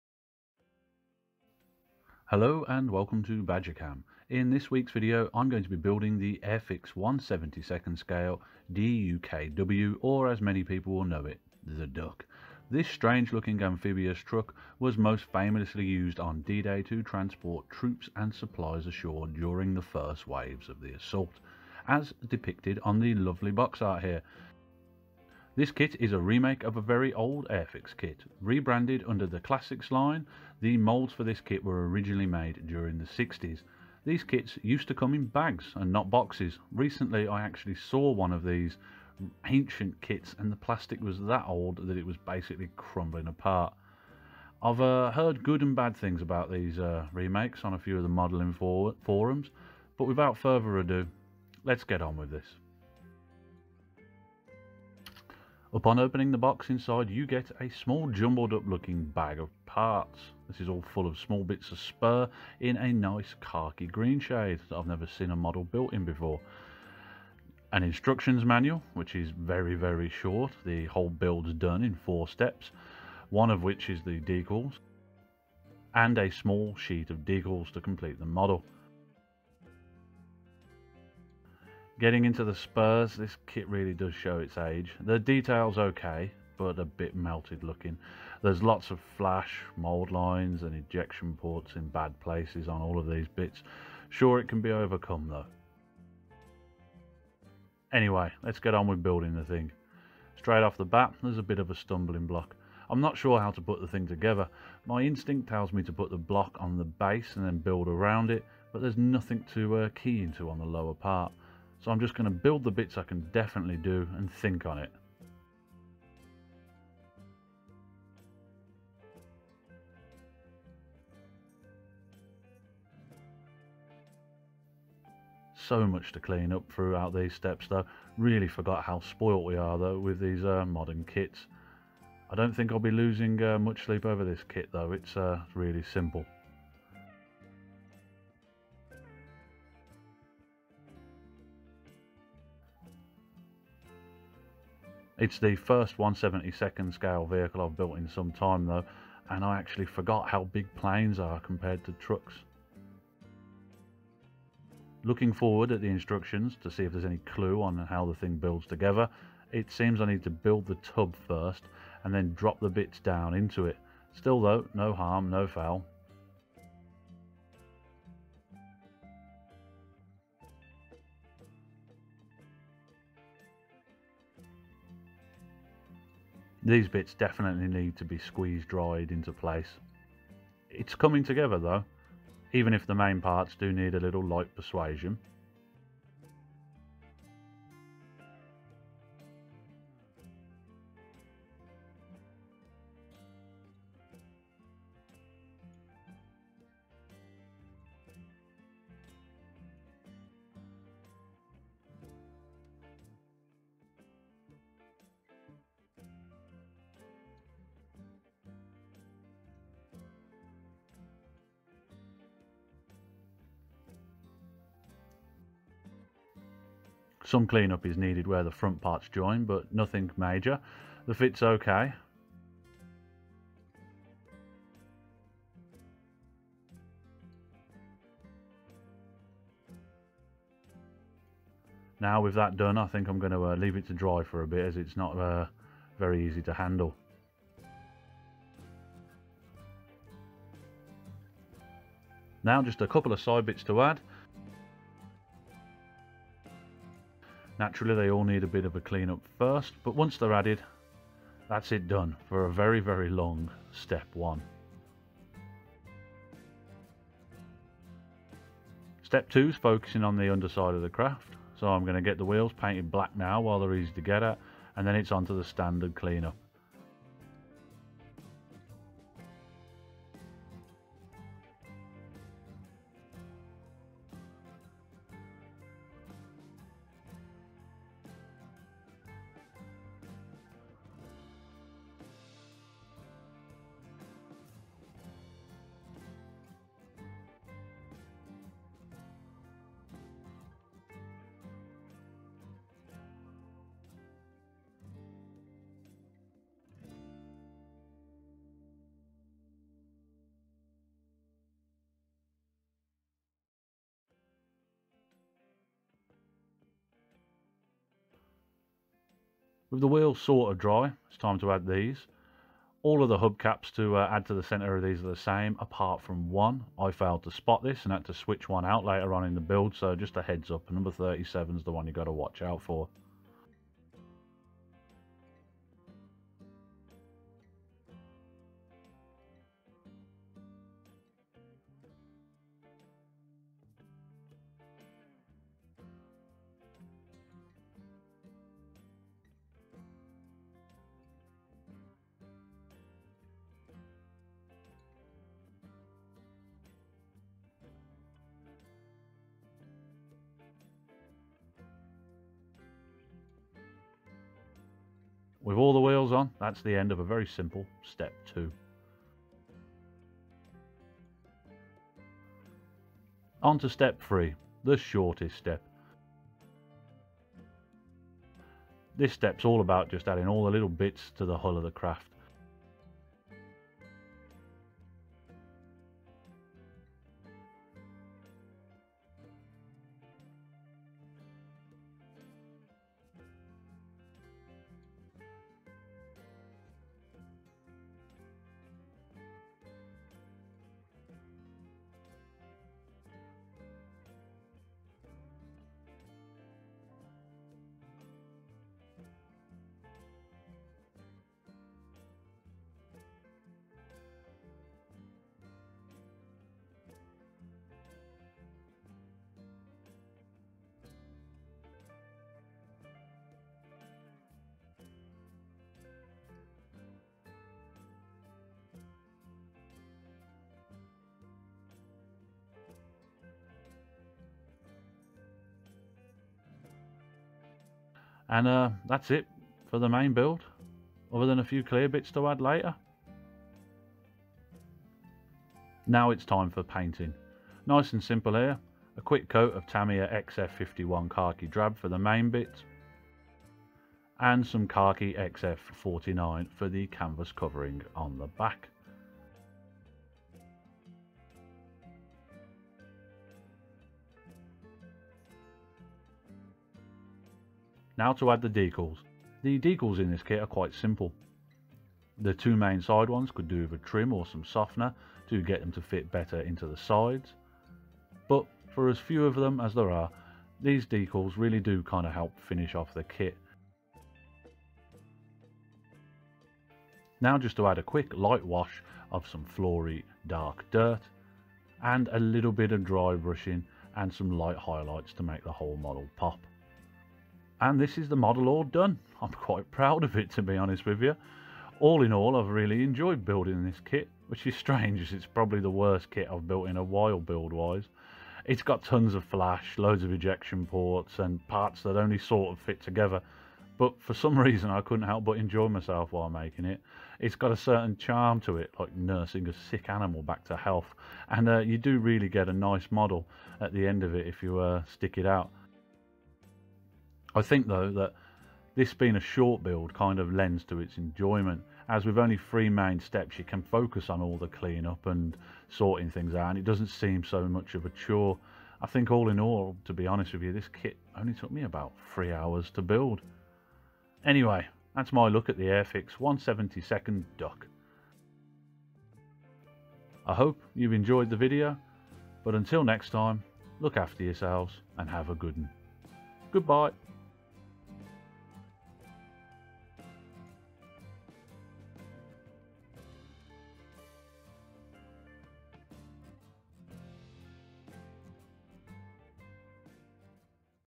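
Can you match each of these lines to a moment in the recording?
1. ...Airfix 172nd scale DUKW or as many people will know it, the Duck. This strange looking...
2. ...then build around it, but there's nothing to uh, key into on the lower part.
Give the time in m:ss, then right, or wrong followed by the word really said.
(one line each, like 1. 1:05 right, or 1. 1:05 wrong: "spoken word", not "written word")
1. 0:06 right
2. 1:47 right.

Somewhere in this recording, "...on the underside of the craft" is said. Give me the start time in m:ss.
4:20.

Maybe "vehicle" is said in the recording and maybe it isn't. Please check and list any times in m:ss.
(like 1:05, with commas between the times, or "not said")
2:27.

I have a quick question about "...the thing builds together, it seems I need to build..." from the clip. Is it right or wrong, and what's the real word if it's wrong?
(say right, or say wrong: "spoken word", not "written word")
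right.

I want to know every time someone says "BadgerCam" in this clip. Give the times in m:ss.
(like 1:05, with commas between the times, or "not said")
0:03.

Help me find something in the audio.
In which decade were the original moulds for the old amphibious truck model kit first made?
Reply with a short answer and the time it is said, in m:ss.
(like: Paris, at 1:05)
1960s, at 0:32.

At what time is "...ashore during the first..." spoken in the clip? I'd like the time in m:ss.
0:18.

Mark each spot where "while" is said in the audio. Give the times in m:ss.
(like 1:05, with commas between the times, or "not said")
4:23, 8:16, 8:26.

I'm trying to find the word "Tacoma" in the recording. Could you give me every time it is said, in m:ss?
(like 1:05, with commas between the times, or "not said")
not said.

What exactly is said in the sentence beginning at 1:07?
An instructions manual, which is very, very short.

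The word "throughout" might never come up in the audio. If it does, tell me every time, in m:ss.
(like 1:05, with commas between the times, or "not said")
2:06.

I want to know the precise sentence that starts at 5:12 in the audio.
All of the hubcaps to uh, add to the centre of these are the same, apart from one.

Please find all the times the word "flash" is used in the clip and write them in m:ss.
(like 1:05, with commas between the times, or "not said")
1:29, 8:19.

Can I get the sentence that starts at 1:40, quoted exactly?
Straight off the bat, there's a bit of a stumbling block.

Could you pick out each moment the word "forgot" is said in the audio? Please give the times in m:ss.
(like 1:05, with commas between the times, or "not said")
2:08, 2:29.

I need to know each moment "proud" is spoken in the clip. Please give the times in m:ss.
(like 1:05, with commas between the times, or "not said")
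8:09.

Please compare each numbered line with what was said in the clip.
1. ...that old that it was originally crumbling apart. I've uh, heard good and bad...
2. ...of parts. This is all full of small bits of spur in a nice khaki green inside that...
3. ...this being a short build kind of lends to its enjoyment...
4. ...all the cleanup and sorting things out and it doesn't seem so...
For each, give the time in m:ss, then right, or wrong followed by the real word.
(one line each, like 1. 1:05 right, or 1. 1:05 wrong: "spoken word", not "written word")
1. 0:41 wrong: "basically", not "originally"
2. 0:59 wrong: "shade", not "inside"
3. 8:38 right
4. 8:44 right.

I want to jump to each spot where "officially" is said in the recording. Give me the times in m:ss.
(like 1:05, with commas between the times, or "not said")
not said.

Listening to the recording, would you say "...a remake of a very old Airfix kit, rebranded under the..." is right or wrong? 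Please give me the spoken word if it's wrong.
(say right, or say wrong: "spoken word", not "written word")
right.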